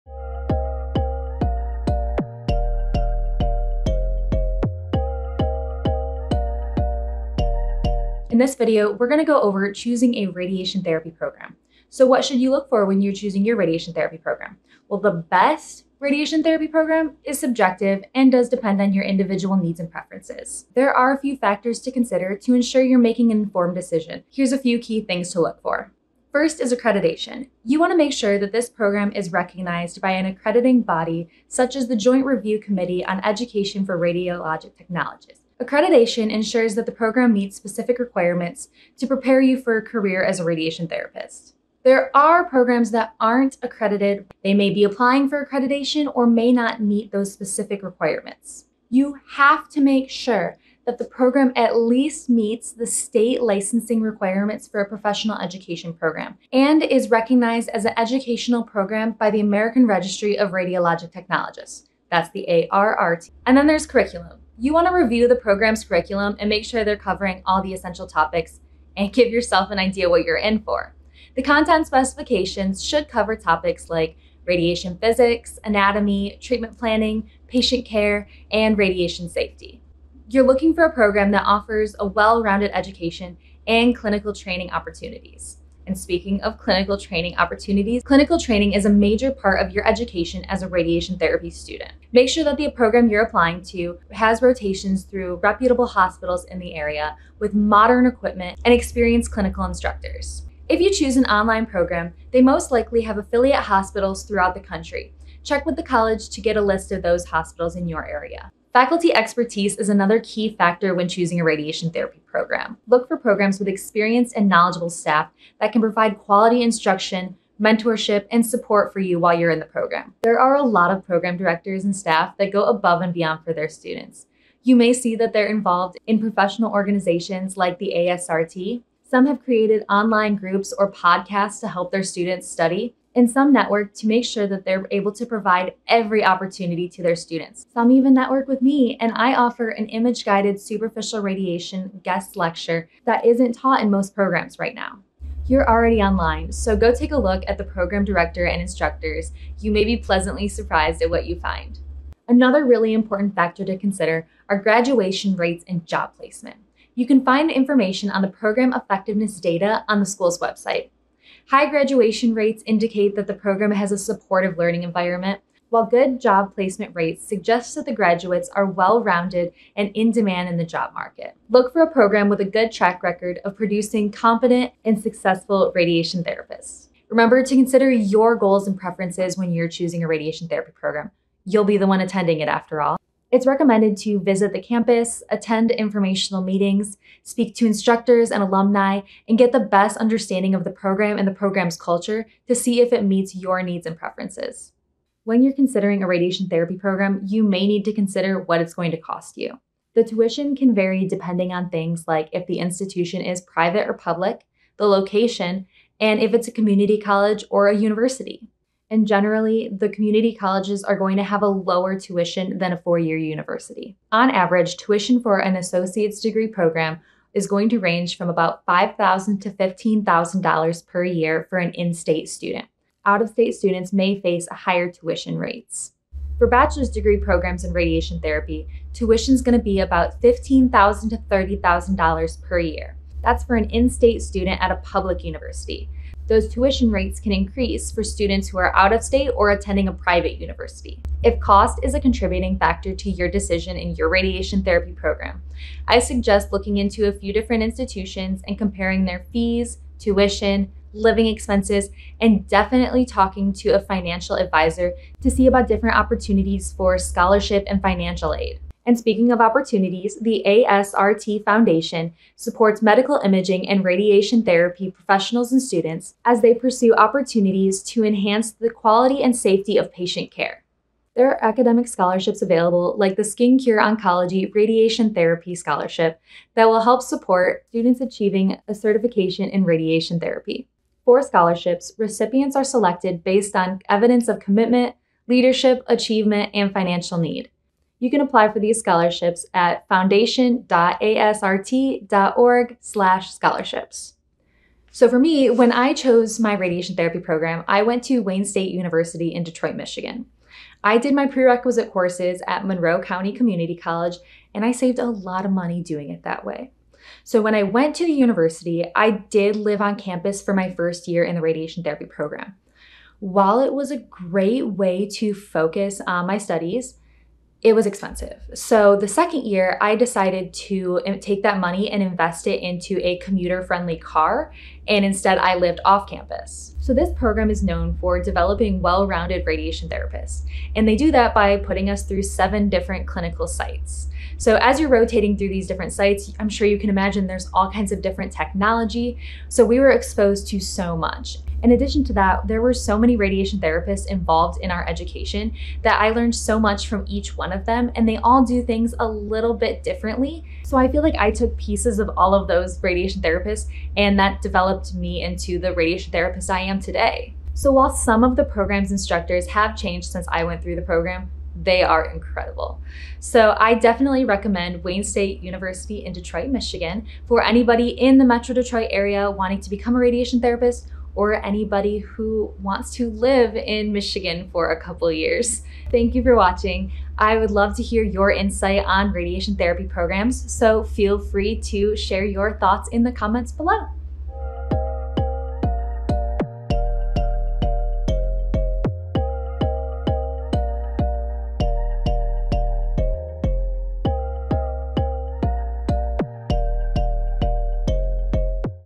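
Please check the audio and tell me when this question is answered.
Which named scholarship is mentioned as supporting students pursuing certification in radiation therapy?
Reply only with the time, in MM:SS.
04:33.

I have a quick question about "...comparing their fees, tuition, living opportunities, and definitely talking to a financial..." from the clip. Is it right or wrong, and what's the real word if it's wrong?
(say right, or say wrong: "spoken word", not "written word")
wrong: "expenses", not "opportunities".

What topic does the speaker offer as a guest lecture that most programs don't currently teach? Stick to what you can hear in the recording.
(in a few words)
Image guided superficial radiation.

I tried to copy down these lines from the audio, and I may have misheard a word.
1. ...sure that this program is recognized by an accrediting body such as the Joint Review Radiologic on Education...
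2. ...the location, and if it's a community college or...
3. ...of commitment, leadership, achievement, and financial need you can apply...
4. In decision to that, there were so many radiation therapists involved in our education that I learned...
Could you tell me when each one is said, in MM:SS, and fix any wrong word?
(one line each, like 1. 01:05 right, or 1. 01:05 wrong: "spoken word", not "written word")
1. 00:28 wrong: "Committee", not "Radiologic"
2. 03:24 right
3. 04:44 right
4. 05:41 wrong: "addition", not "decision".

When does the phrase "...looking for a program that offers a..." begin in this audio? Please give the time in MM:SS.
01:20.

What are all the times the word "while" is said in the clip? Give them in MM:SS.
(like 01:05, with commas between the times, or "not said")
01:59, 02:45, 05:13, 05:57.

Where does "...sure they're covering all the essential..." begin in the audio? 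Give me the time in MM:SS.
01:06.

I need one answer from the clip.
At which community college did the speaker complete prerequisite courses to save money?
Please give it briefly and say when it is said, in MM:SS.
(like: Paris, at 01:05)
Monroe County Community College, at 05:02.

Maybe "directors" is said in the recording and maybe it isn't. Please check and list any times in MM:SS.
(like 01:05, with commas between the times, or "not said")
02:01, 02:28.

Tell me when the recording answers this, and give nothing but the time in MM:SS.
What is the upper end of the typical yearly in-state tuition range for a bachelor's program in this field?
03:51.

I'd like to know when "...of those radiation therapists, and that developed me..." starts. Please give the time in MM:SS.
05:52.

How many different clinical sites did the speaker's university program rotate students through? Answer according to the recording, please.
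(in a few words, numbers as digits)
7.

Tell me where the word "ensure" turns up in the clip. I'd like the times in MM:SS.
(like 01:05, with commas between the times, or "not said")
00:22, 00:36.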